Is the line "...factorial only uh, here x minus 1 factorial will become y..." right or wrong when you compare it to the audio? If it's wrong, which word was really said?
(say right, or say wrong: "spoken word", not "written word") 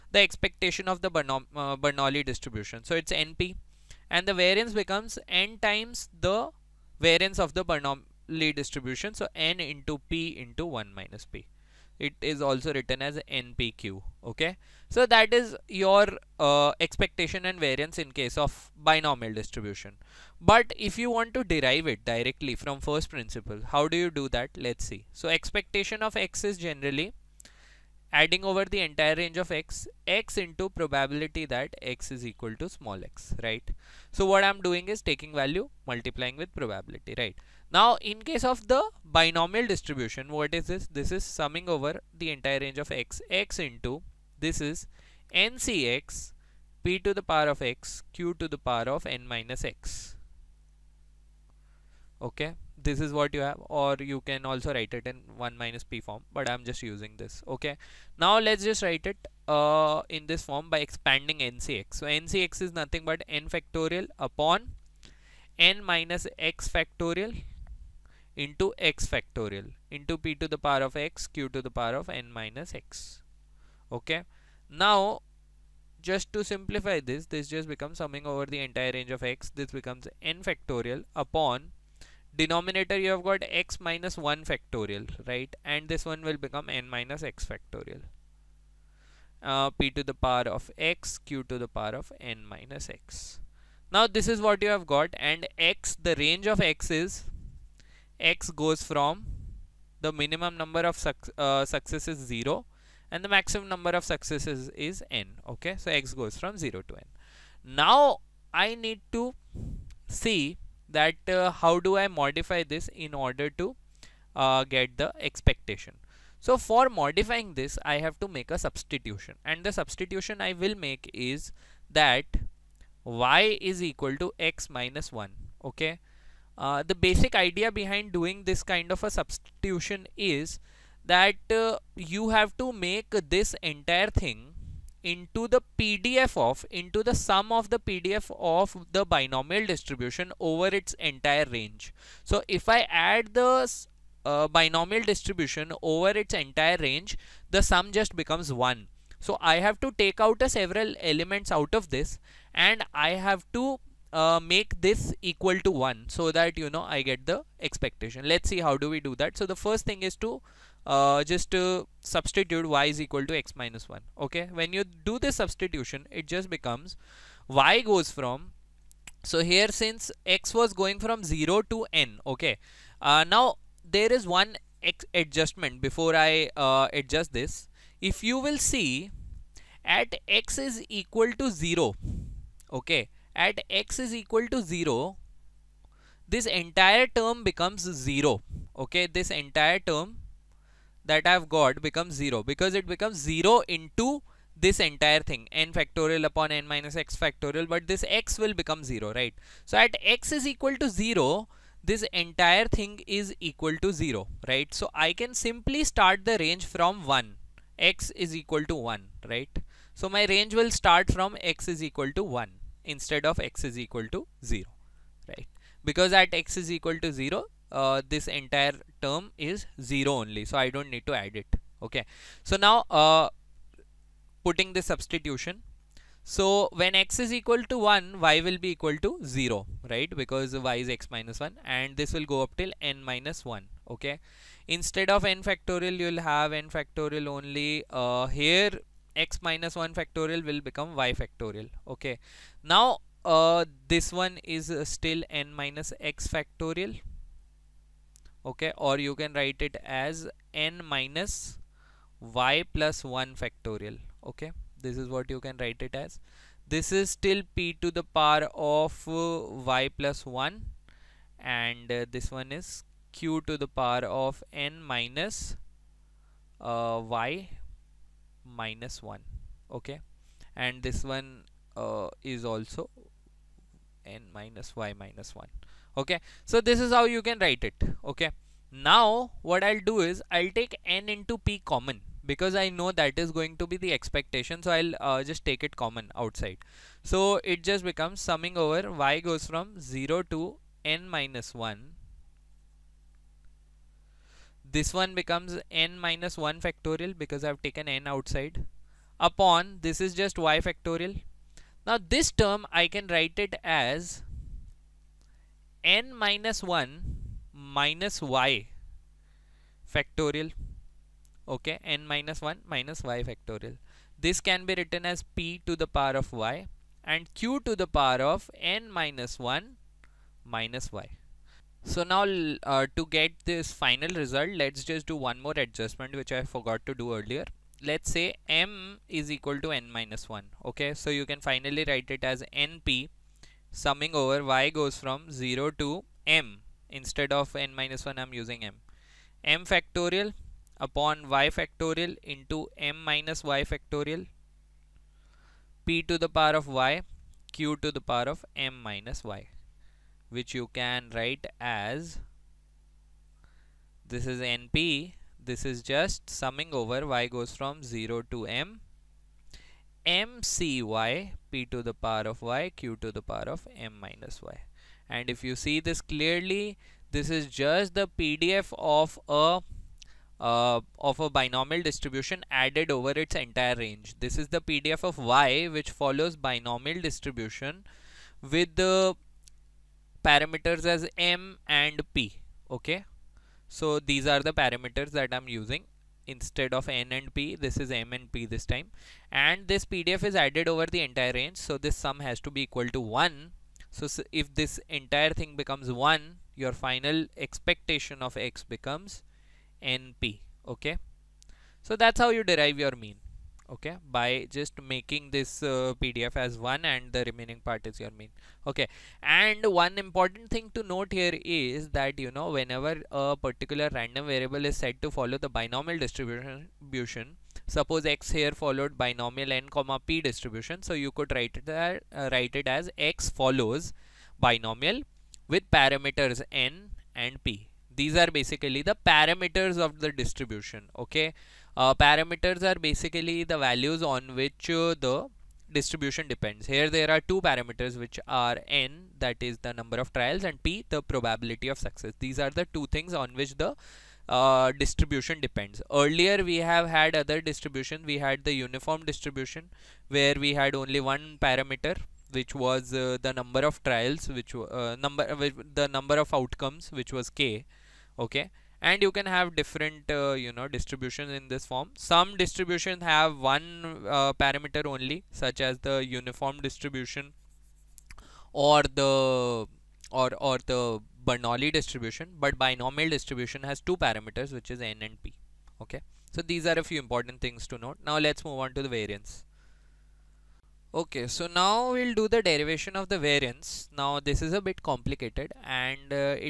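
right.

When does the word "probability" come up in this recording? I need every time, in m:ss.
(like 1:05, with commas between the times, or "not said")
0:30, 0:36, 7:21.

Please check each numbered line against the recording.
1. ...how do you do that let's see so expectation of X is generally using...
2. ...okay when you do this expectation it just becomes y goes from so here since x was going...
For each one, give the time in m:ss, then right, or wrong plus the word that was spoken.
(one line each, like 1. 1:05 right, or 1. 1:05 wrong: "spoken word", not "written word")
1. 0:23 wrong: "adding", not "using"
2. 2:44 wrong: "substitution", not "expectation".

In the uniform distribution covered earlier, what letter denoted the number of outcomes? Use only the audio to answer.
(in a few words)
k.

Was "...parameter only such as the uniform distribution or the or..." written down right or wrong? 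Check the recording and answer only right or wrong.
right.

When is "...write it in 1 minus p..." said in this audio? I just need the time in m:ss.
0:54.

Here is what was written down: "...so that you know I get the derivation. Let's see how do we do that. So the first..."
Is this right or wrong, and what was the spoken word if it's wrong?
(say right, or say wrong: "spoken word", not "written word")
wrong: "expectation", not "derivation".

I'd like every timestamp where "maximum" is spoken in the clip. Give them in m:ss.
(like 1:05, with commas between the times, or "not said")
1:43.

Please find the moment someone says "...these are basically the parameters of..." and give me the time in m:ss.
7:07.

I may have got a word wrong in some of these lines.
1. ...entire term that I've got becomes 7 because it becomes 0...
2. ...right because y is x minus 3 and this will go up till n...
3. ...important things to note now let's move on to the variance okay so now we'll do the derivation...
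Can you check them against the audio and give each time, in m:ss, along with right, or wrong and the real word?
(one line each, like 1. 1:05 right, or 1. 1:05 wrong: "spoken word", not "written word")
1. 3:09 wrong: "0", not "7"
2. 3:49 wrong: "1", not "3"
3. 7:56 right.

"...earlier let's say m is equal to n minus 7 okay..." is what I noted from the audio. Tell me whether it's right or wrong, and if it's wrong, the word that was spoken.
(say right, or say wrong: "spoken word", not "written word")
wrong: "1", not "7".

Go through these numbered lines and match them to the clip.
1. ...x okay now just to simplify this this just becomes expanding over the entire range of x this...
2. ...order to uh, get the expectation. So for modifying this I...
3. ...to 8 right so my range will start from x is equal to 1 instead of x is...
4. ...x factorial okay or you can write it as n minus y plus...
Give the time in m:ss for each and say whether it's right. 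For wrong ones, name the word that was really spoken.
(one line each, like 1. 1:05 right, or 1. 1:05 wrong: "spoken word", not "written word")
1. 1:12 wrong: "summing", not "expanding"
2. 1:53 right
3. 3:28 wrong: "1", not "8"
4. 4:05 right.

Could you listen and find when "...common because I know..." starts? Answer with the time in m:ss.
4:41.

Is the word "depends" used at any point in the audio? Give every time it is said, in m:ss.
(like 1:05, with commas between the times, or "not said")
7:16, 7:25.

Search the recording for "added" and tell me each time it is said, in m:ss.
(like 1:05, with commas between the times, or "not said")
6:12, 6:30.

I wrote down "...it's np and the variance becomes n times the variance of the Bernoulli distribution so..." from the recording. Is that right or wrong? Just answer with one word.
right.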